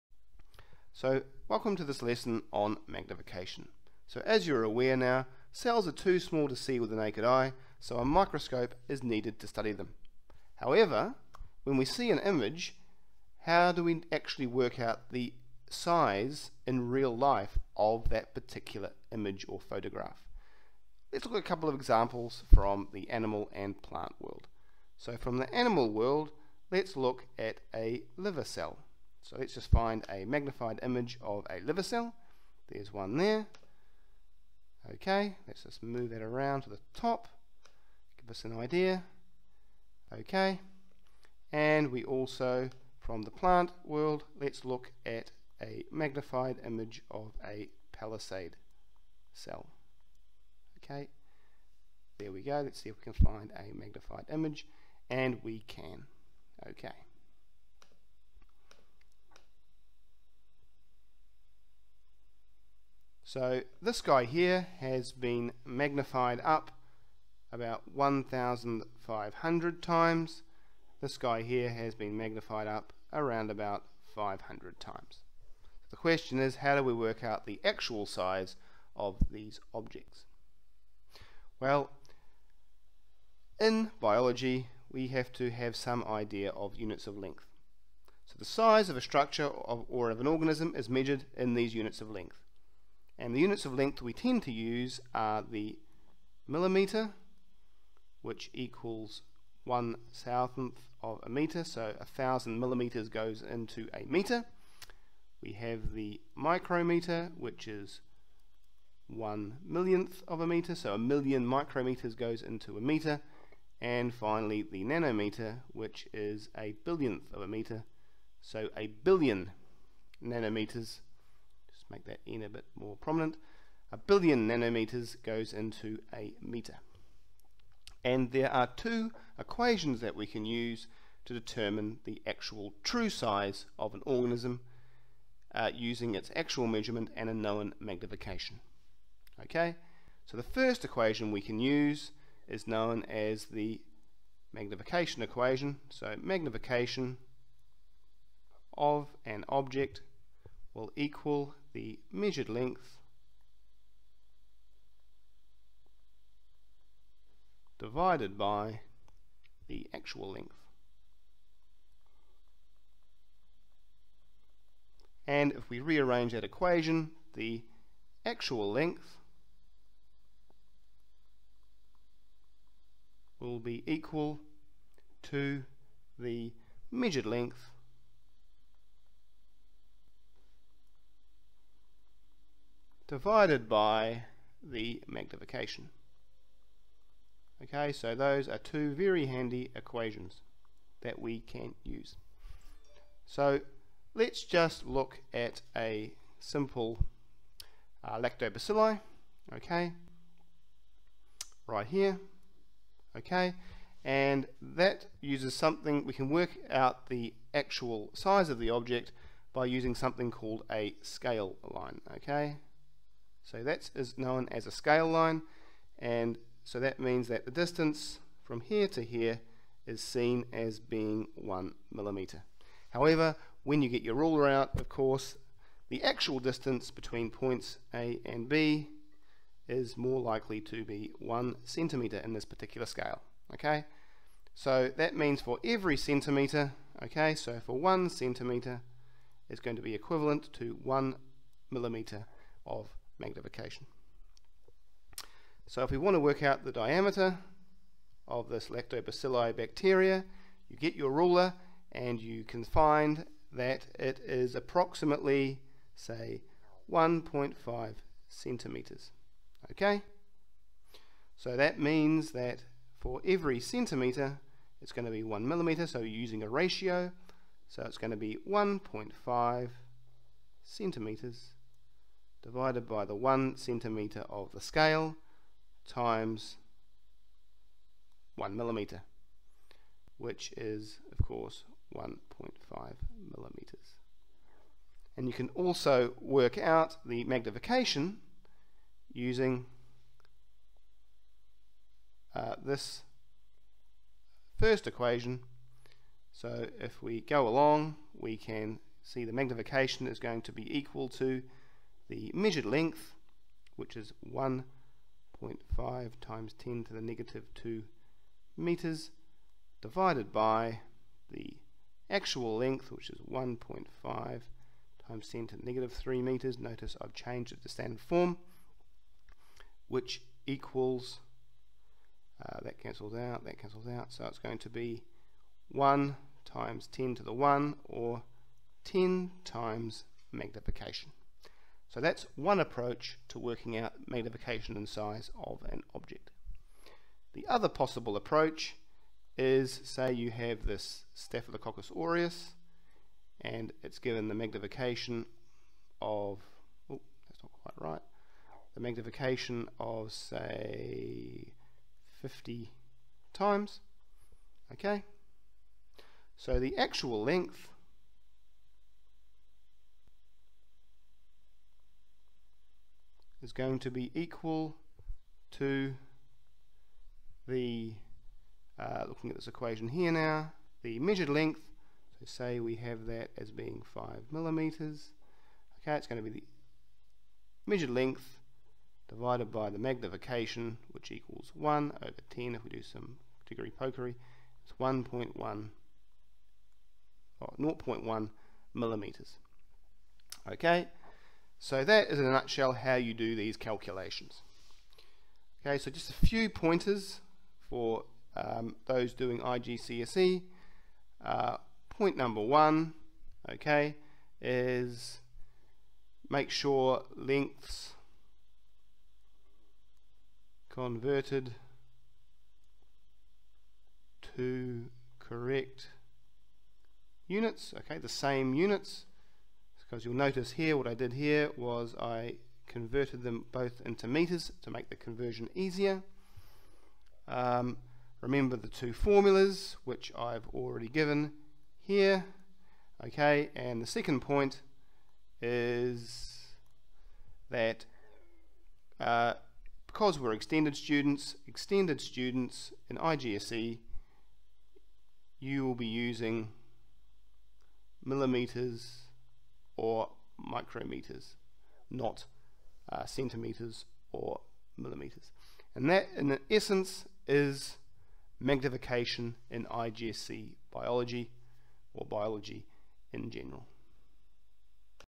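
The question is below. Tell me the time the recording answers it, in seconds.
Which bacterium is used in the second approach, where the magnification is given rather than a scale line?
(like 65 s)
341 s.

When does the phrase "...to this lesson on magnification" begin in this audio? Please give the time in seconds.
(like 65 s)
1 s.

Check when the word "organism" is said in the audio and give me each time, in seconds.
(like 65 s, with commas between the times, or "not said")
90 s, 134 s.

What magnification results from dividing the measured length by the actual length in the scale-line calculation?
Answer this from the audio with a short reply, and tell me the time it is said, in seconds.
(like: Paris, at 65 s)
10 times, at 328 s.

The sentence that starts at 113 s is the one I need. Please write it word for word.
And finally, the nanometer, which is a billionth of a meter, so a billion nanometers make that n a bit more prominent.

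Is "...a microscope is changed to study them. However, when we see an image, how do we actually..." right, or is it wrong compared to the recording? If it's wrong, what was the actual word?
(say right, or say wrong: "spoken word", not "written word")
wrong: "needed", not "changed".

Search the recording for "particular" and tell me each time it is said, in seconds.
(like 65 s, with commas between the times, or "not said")
18 s, 232 s.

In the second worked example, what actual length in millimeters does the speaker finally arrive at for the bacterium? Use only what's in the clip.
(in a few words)
0.1 millimeters.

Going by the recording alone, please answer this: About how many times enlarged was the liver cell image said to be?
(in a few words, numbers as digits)
1,500 times.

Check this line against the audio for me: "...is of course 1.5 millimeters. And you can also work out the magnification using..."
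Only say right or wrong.
right.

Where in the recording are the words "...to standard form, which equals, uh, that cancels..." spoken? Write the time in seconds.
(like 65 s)
317 s.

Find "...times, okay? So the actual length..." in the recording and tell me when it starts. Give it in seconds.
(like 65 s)
353 s.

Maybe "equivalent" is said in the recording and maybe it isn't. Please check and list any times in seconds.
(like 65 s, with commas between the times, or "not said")
239 s.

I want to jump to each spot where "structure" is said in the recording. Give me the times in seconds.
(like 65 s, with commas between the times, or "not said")
89 s.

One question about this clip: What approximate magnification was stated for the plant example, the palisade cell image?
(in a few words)
500 times.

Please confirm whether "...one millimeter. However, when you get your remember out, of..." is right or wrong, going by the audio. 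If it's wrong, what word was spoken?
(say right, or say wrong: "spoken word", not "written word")
wrong: "ruler", not "remember".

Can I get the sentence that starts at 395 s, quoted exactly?
Okay, so just a few pointers for um, those doing IGCSE.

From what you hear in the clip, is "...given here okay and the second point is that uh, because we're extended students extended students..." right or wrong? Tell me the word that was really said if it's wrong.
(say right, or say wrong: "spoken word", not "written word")
right.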